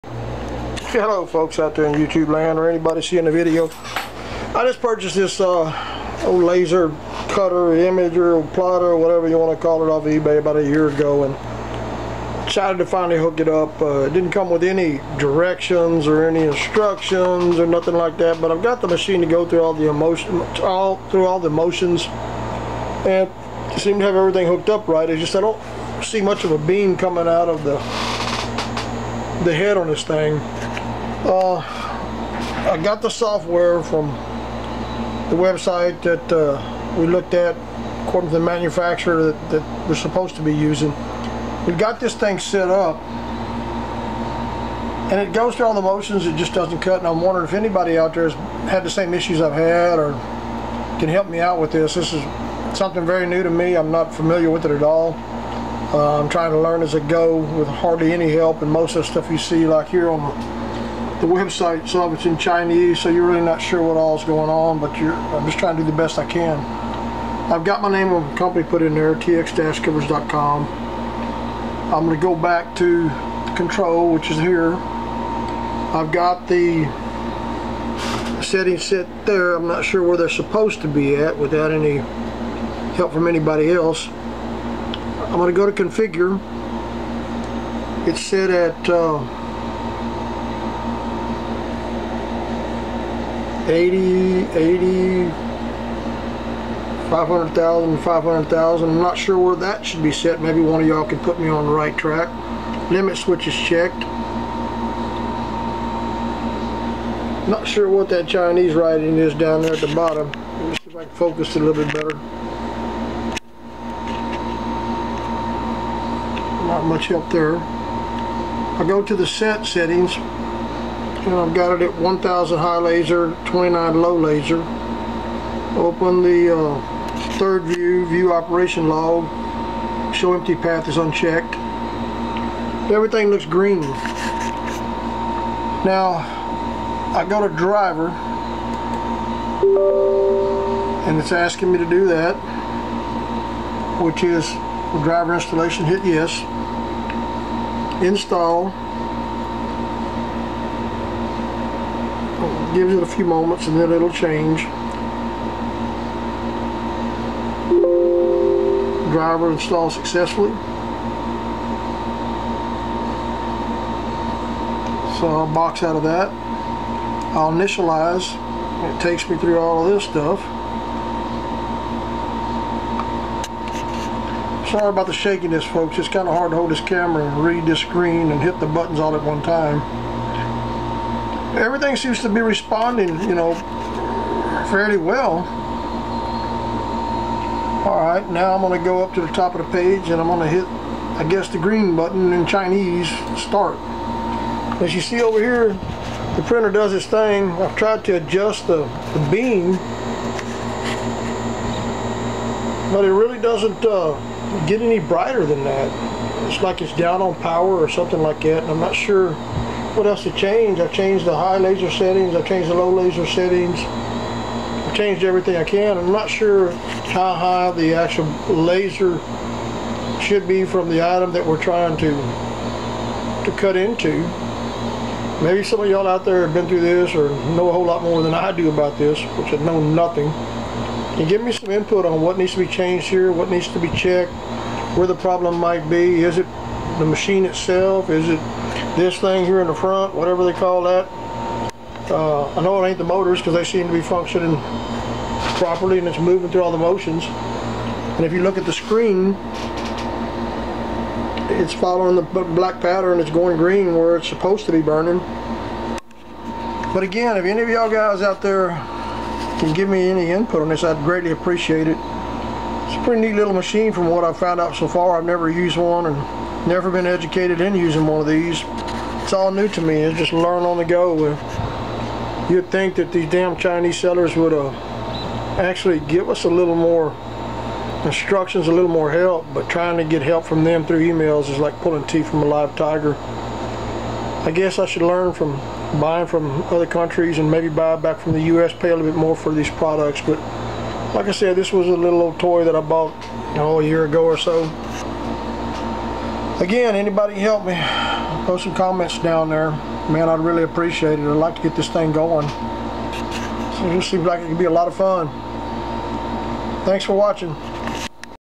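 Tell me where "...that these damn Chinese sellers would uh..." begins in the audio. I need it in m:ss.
4:32.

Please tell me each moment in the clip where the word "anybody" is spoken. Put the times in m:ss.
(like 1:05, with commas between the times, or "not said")
0:02, 0:47, 1:23, 4:56.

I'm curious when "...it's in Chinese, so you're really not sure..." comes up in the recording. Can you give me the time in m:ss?
1:02.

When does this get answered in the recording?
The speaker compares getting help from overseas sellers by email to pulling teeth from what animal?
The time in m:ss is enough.
4:42.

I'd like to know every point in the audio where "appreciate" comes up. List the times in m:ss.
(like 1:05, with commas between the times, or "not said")
4:21, 5:00.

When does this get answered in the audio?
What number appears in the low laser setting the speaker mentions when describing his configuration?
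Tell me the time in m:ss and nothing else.
2:03.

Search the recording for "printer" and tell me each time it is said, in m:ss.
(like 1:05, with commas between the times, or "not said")
3:16.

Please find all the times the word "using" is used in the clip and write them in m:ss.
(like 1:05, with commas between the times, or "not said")
0:40, 4:27.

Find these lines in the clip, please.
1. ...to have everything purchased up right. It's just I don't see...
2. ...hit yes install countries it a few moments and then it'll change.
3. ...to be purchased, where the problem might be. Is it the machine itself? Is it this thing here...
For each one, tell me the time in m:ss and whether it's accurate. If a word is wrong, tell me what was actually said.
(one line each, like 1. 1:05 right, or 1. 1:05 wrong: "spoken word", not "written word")
1. 0:23 wrong: "hooked", not "purchased"
2. 2:25 wrong: "gives", not "countries"
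3. 3:53 wrong: "checked", not "purchased".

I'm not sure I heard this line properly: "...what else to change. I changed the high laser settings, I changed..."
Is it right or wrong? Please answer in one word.
right.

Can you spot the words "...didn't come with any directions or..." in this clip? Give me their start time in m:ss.
0:14.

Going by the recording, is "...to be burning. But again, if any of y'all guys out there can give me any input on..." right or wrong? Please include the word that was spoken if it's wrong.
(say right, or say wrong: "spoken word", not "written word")
right.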